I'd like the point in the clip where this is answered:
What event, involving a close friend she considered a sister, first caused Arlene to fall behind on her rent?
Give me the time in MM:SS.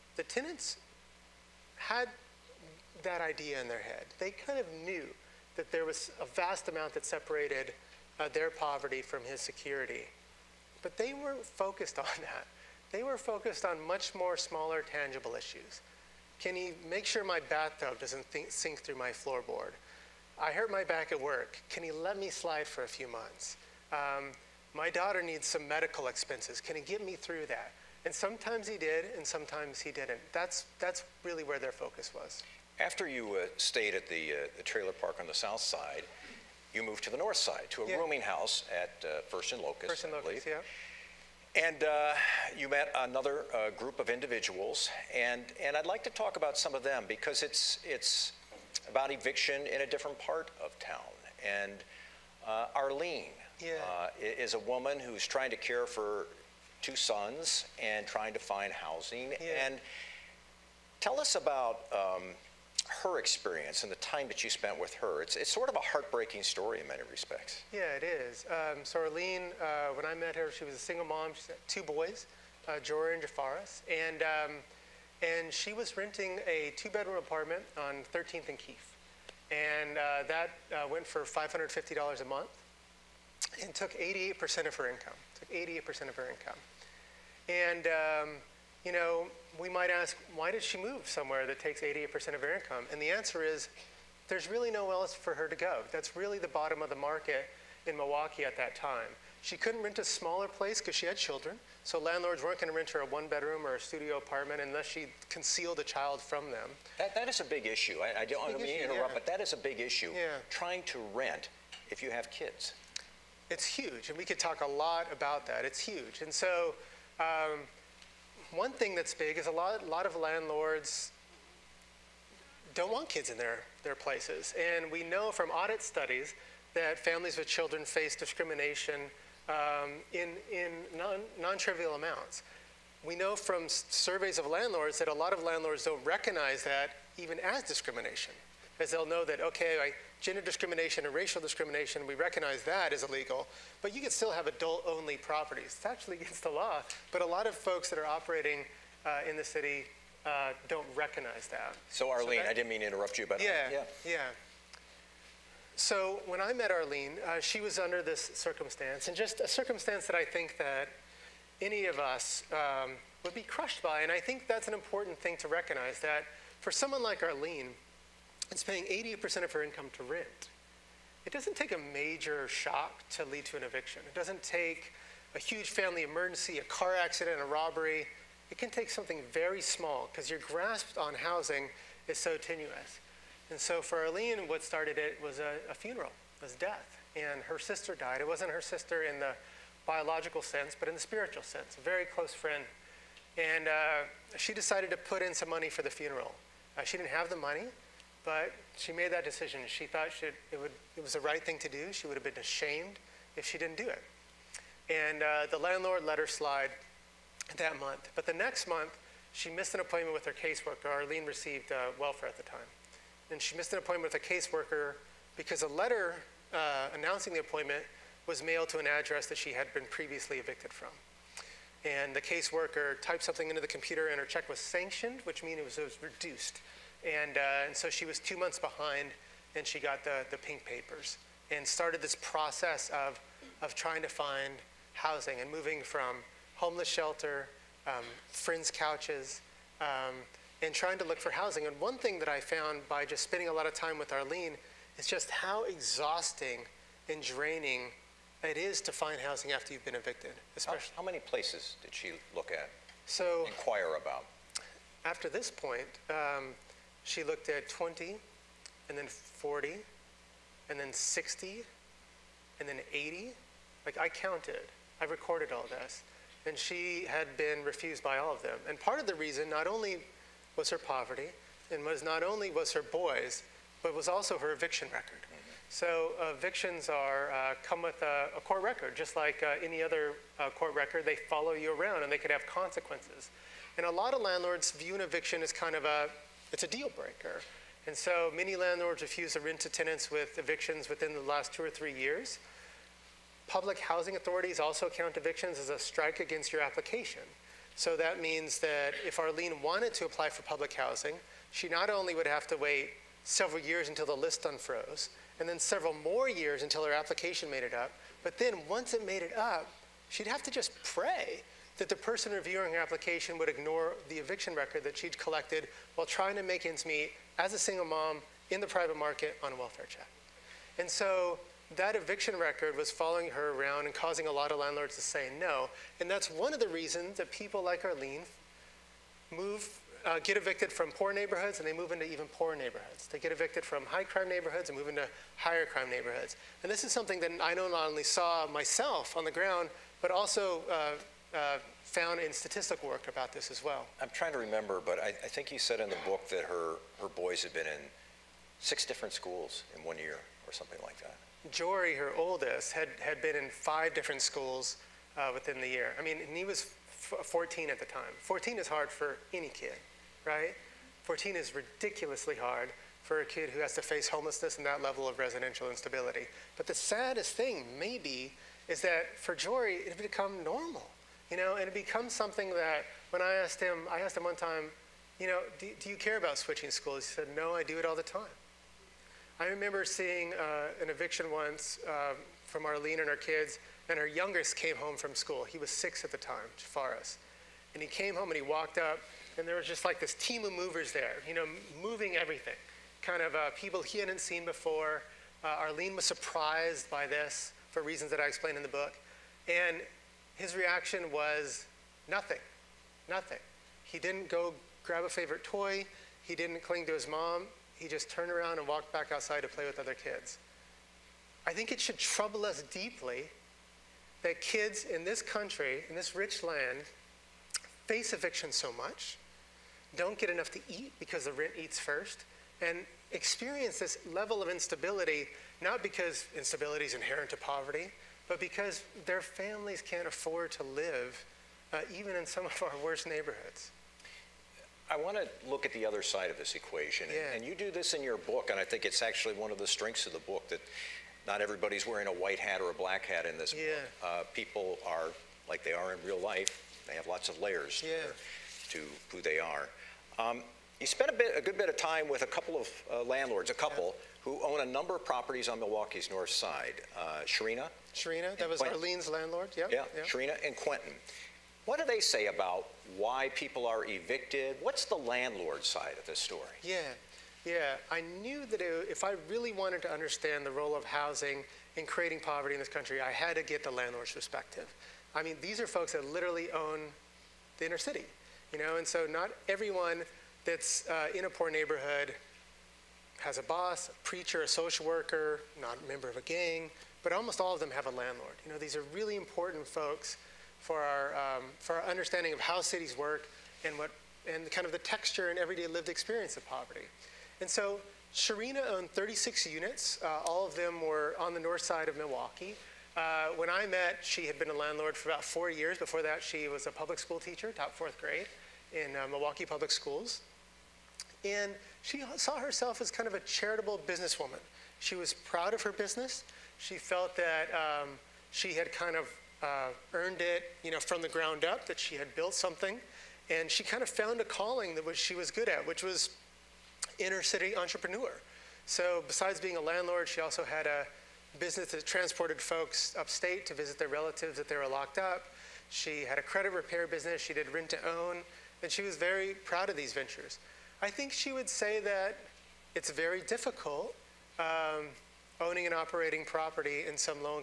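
03:05.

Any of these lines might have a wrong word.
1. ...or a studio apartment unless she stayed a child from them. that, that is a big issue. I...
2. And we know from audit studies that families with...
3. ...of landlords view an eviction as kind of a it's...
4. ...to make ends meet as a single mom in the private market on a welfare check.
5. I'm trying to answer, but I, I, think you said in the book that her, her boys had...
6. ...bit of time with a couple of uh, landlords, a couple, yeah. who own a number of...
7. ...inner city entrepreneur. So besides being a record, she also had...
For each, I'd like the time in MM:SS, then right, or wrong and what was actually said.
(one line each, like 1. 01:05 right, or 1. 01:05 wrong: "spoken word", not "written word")
1. 01:43 wrong: "concealed", not "stayed"
2. 02:04 right
3. 04:44 right
4. 05:16 right
5. 05:44 wrong: "remember", not "answer"
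6. 07:31 right
7. 08:46 wrong: "landlord", not "record".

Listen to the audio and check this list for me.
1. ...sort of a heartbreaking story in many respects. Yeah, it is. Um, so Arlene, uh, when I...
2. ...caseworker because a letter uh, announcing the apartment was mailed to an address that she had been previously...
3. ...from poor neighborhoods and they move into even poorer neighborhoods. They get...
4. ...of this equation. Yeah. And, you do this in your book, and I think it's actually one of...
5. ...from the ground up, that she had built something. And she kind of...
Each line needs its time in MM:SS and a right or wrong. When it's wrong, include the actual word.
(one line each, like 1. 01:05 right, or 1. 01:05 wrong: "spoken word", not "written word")
1. 01:05 right
2. 03:34 wrong: "appointment", not "apartment"
3. 05:30 right
4. 07:16 right
5. 08:40 right.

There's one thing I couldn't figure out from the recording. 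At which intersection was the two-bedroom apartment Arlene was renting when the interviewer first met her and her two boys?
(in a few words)
13th and Keefe.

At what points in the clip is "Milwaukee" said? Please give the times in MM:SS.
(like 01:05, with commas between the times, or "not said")
01:37, 07:35, 08:21, 08:29.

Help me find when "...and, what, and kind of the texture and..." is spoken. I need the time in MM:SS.
08:13.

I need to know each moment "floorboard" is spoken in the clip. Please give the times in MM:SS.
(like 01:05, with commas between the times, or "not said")
00:19.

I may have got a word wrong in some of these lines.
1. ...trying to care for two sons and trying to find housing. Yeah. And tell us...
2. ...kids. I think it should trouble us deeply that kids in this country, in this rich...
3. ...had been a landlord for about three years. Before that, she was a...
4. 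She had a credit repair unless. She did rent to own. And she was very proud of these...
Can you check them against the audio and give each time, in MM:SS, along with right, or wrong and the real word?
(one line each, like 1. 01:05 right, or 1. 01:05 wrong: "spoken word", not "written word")
1. 00:55 right
2. 06:49 right
3. 08:24 wrong: "four", not "three"
4. 08:55 wrong: "business", not "unless".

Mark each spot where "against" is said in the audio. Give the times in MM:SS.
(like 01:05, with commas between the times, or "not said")
02:26, 04:56.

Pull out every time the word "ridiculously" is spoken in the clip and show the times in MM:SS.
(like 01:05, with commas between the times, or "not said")
06:01.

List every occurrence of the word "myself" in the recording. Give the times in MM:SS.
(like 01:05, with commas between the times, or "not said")
05:38.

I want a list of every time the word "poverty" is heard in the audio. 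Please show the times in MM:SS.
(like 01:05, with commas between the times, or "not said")
00:08, 04:30, 07:07, 07:52, 08:16.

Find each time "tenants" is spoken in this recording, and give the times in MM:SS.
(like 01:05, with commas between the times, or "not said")
00:00, 04:49.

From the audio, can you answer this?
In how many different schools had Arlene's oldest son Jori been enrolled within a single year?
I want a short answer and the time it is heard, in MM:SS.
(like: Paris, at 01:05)
5, at 05:53.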